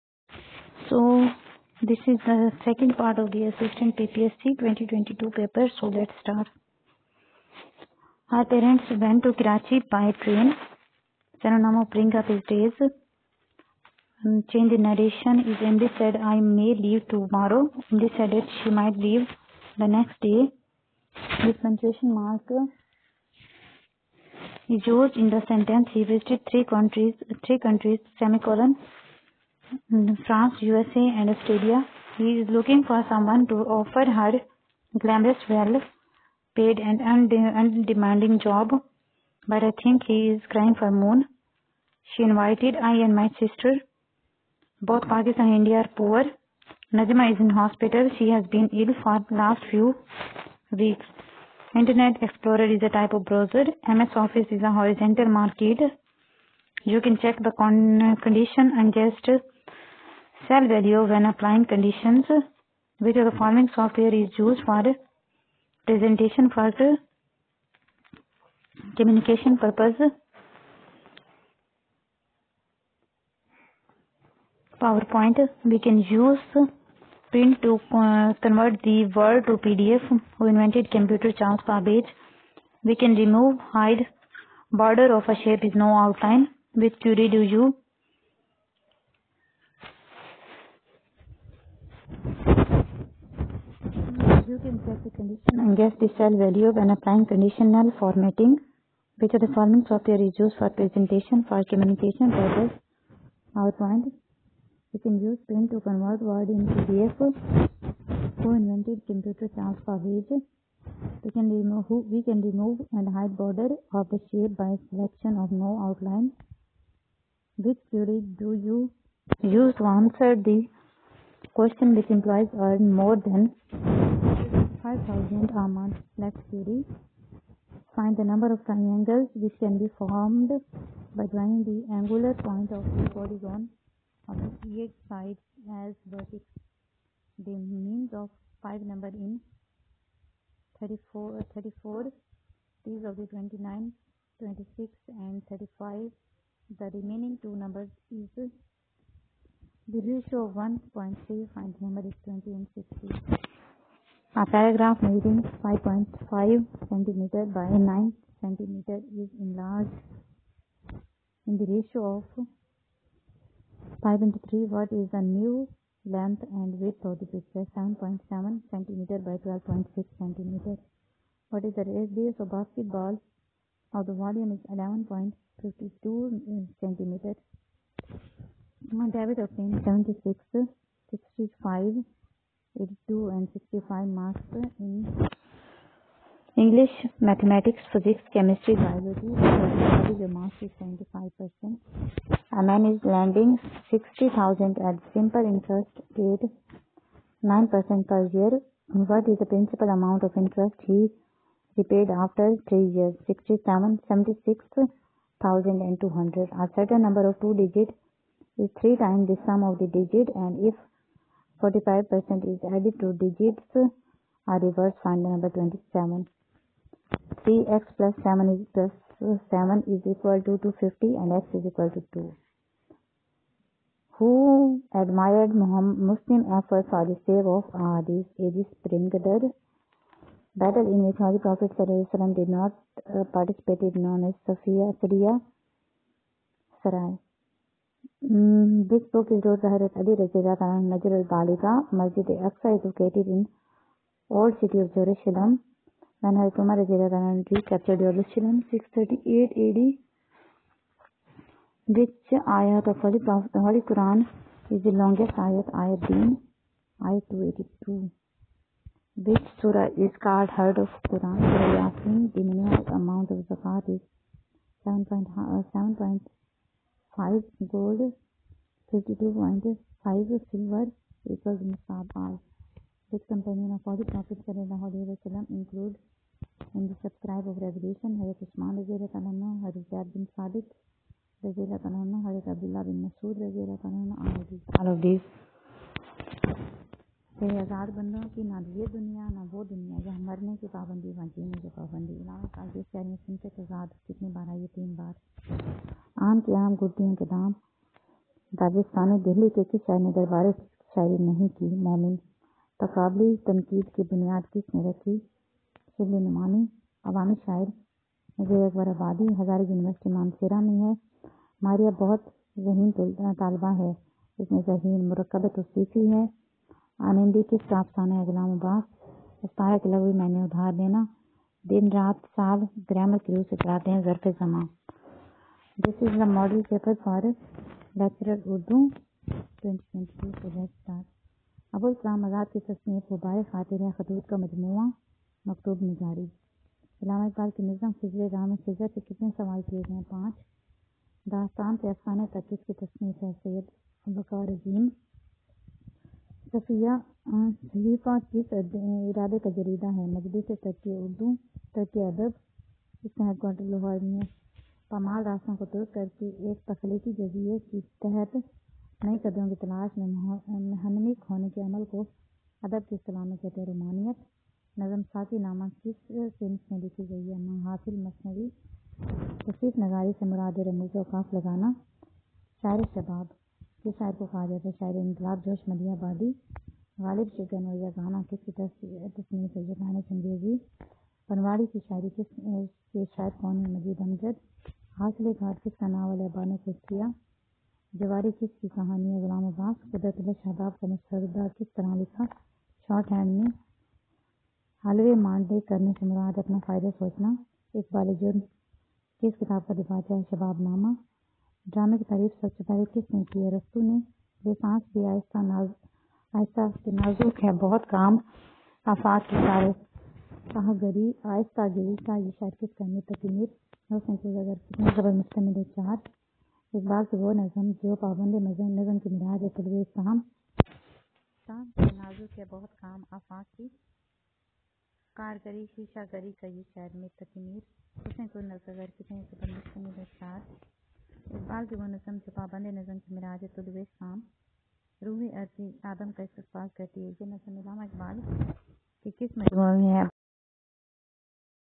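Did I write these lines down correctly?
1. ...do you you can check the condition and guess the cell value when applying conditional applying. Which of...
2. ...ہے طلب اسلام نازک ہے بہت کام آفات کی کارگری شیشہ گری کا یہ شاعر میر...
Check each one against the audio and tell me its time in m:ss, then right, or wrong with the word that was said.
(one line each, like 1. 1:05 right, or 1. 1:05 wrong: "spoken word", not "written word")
1. 1:27 wrong: "formatting", not "applying"
2. 6:59 right.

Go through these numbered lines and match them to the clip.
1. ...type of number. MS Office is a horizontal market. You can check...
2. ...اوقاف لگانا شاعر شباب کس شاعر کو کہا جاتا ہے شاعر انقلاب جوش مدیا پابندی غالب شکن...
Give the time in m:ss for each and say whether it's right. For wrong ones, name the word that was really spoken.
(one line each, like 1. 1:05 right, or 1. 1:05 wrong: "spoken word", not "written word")
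1. 0:52 wrong: "browser", not "number"
2. 6:11 wrong: "آبادی", not "پابندی".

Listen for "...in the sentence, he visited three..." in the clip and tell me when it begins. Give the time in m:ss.
0:25.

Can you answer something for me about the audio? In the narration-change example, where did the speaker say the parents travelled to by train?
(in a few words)
Karachi.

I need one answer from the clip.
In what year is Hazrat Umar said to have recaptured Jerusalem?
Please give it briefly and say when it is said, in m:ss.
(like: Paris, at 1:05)
638 AD, at 4:08.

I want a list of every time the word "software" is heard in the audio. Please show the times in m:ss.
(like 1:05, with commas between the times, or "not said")
1:03, 1:39.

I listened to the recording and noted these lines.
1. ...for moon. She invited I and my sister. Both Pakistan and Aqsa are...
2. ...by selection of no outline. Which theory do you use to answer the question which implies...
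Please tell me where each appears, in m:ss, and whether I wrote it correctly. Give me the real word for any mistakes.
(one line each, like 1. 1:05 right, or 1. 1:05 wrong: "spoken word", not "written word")
1. 0:40 wrong: "India", not "Aqsa"
2. 1:54 right.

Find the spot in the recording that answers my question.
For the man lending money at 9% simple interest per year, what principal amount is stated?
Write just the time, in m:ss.
3:13.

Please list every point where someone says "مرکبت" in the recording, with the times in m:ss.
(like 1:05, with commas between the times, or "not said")
5:15.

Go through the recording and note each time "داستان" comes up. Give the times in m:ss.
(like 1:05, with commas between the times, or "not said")
5:41.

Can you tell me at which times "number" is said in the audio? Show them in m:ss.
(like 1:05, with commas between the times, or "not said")
2:08, 2:18, 2:27, 2:31, 3:27, 3:35.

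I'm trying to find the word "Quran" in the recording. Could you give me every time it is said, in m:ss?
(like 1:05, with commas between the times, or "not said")
4:13, 4:21.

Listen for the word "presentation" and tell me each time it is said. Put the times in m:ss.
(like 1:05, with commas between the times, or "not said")
1:05, 1:40.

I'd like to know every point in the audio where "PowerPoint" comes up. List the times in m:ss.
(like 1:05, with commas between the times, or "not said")
1:14, 1:43.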